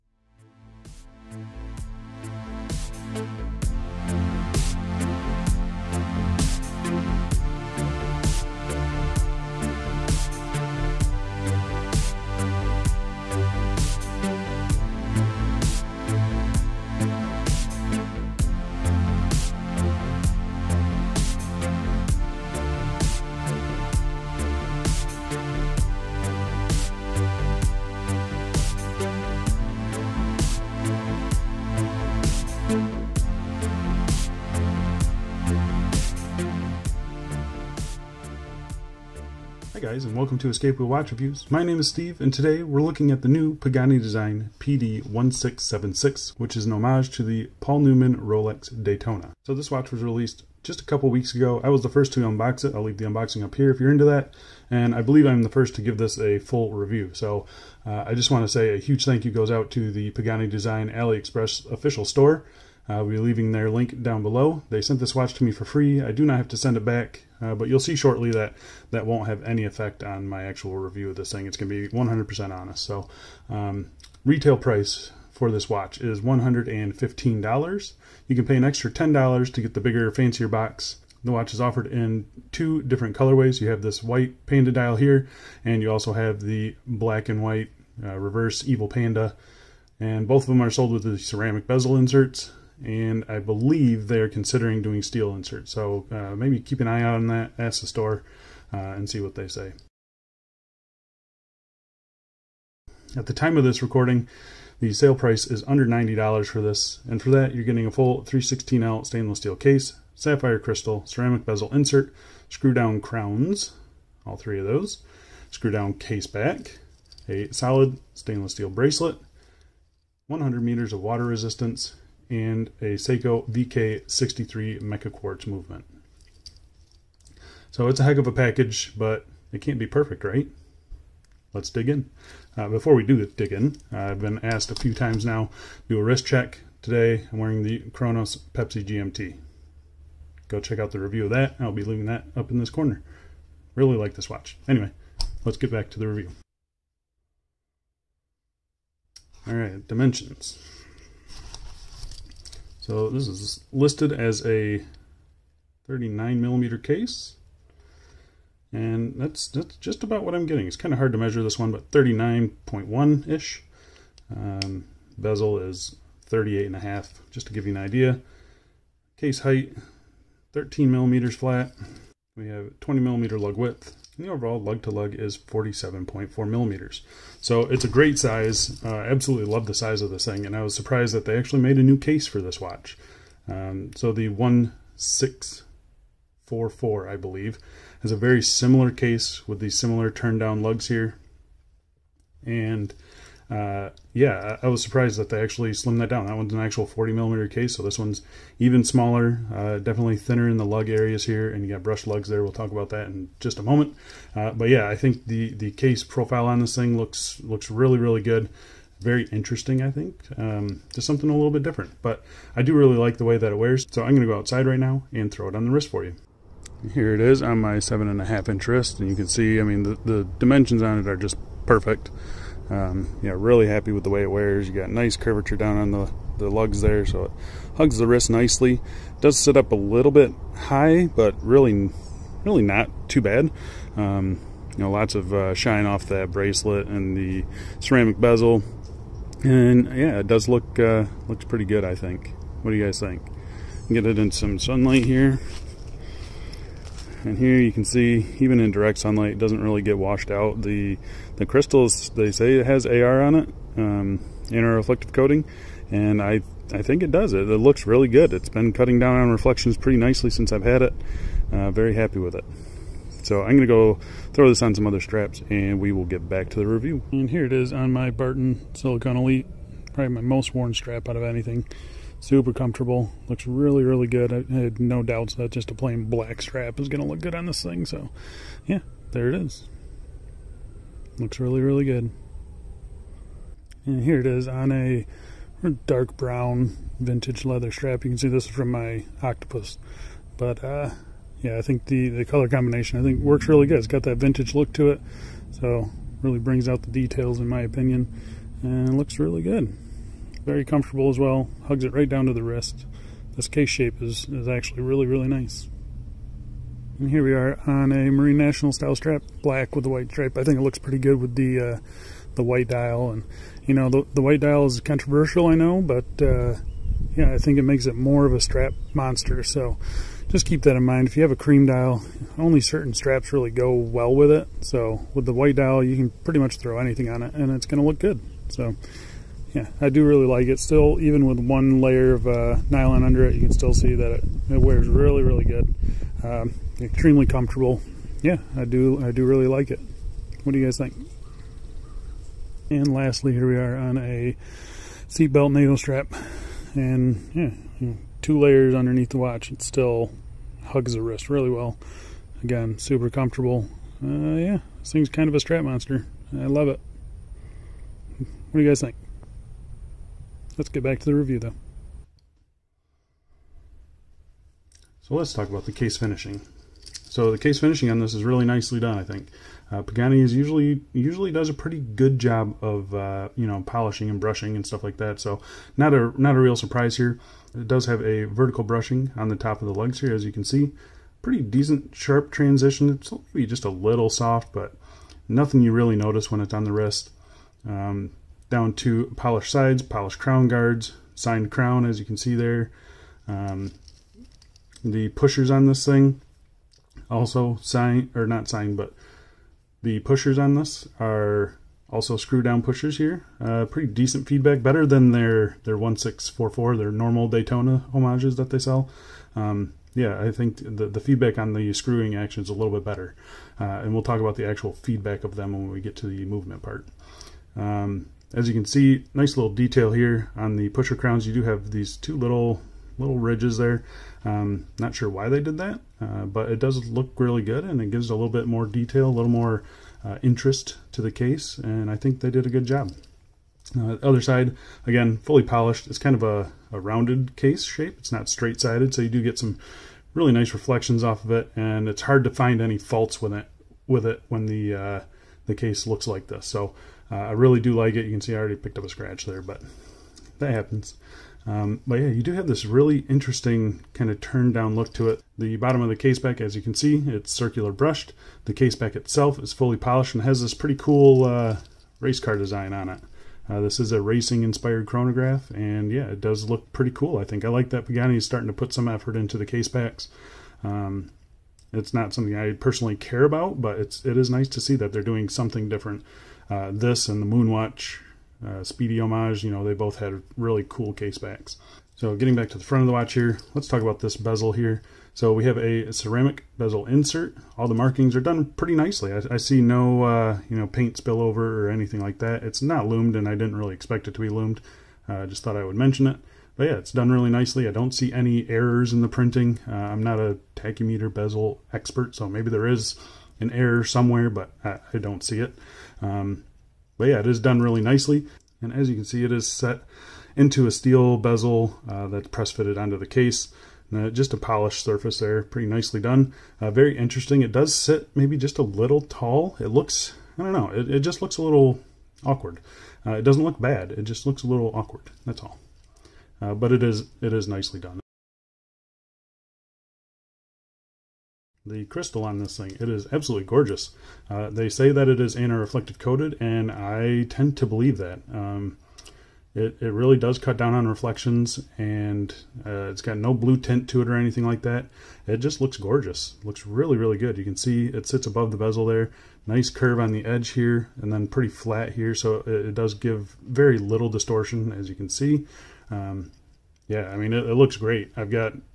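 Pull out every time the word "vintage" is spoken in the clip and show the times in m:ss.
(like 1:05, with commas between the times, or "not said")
4:46, 4:54.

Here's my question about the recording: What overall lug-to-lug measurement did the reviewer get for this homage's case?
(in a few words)
47.4 mm.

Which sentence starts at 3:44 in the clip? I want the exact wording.
You got nice curvature down on the, the lugs there, so it hugs the wrist nicely.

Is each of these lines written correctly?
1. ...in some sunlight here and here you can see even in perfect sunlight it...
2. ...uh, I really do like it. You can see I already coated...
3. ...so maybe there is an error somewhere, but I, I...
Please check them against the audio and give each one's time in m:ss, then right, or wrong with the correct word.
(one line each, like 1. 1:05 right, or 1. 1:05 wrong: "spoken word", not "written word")
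1. 4:04 wrong: "direct", not "perfect"
2. 7:27 wrong: "picked", not "coated"
3. 8:22 right.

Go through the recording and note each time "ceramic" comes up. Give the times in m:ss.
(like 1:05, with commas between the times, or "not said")
1:31, 1:51, 3:57, 8:05.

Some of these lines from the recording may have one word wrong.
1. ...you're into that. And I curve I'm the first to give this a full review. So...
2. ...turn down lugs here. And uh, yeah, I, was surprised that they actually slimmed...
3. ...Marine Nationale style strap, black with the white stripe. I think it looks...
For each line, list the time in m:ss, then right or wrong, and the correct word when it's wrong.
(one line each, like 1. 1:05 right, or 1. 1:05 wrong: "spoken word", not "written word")
1. 0:53 wrong: "believe", not "curve"
2. 3:10 right
3. 5:08 right.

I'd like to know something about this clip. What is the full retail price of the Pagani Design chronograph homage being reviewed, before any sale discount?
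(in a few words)
$115.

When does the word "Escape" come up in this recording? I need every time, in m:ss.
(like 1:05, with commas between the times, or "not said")
0:40.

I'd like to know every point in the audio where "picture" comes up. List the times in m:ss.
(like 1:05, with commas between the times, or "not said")
not said.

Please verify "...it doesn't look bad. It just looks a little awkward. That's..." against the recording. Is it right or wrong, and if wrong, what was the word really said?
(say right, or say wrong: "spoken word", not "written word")
right.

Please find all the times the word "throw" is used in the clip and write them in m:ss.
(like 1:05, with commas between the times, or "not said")
3:35, 4:24, 5:26.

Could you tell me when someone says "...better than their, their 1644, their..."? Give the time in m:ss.
6:44.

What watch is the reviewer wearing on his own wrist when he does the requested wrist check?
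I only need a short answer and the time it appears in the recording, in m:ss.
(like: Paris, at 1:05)
Cronos Pepsi GMT, at 2:17.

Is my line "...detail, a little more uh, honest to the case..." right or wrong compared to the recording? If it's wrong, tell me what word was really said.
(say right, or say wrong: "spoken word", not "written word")
wrong: "interest", not "honest".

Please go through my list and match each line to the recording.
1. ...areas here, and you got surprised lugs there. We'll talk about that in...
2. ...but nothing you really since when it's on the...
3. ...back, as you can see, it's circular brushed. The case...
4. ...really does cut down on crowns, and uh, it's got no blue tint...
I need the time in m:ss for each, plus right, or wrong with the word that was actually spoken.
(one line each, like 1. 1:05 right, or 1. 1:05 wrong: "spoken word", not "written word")
1. 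3:20 wrong: "brushed", not "surprised"
2. 6:24 wrong: "notice", not "since"
3. 7:36 right
4. 8:59 wrong: "reflections", not "crowns".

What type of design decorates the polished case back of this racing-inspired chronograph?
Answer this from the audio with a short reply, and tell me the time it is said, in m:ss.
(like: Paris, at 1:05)
race car, at 7:41.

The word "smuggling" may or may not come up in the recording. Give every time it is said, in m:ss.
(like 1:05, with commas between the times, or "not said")
not said.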